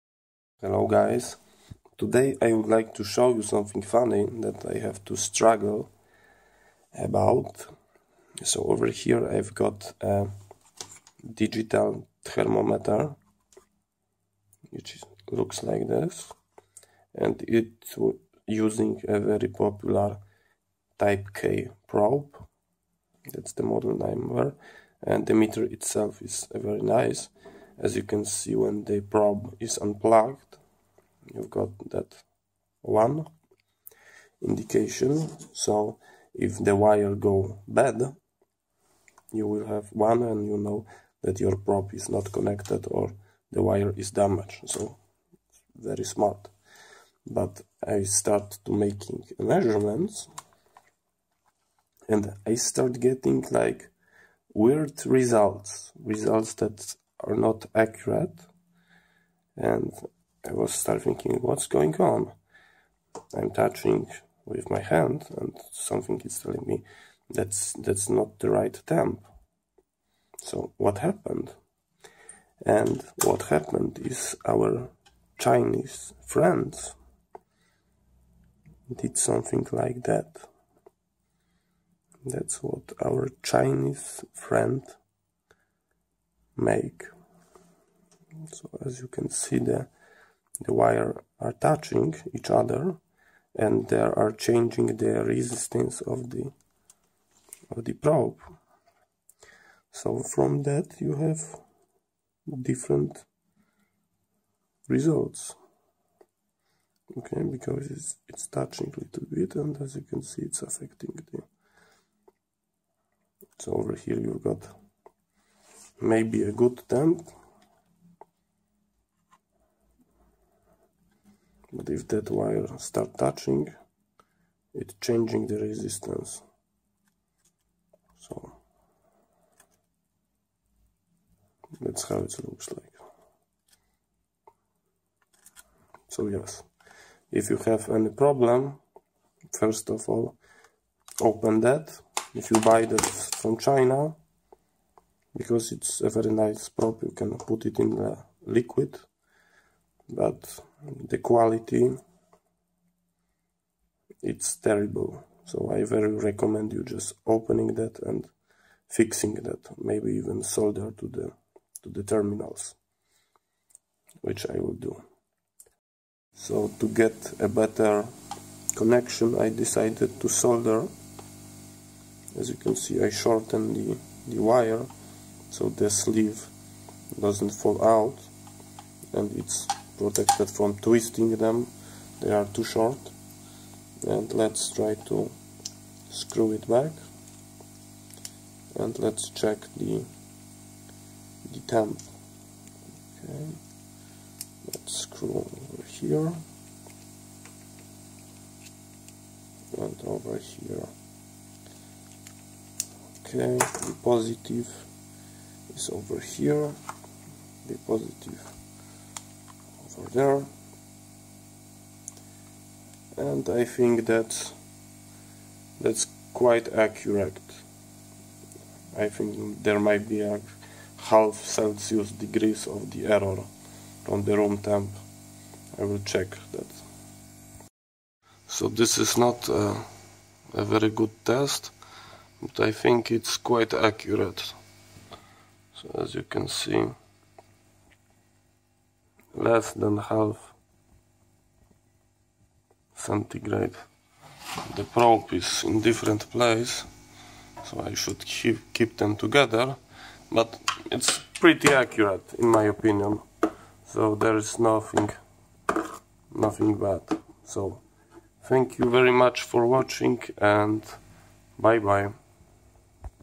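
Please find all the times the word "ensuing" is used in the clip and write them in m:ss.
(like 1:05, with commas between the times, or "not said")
not said.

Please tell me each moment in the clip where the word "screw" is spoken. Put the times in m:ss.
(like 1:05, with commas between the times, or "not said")
3:06, 3:15.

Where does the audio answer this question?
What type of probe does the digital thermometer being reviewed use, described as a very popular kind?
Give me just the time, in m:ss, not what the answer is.
0:20.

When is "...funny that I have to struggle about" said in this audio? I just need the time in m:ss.
0:03.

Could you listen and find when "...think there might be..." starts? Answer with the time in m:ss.
3:39.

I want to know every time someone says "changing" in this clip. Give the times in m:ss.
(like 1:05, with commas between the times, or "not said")
1:34, 2:04.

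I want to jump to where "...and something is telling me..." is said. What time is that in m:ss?
1:05.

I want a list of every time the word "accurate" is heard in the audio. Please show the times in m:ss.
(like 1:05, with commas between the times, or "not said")
0:57, 3:36, 3:53, 4:11.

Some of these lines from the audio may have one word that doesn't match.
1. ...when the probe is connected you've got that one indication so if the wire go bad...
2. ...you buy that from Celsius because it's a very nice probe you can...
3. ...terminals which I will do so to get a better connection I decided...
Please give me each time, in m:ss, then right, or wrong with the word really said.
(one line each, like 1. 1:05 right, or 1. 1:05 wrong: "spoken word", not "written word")
1. 0:28 wrong: "unplugged", not "connected"
2. 2:22 wrong: "China", not "Celsius"
3. 2:42 right.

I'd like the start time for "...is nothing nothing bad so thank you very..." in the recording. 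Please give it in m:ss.
4:14.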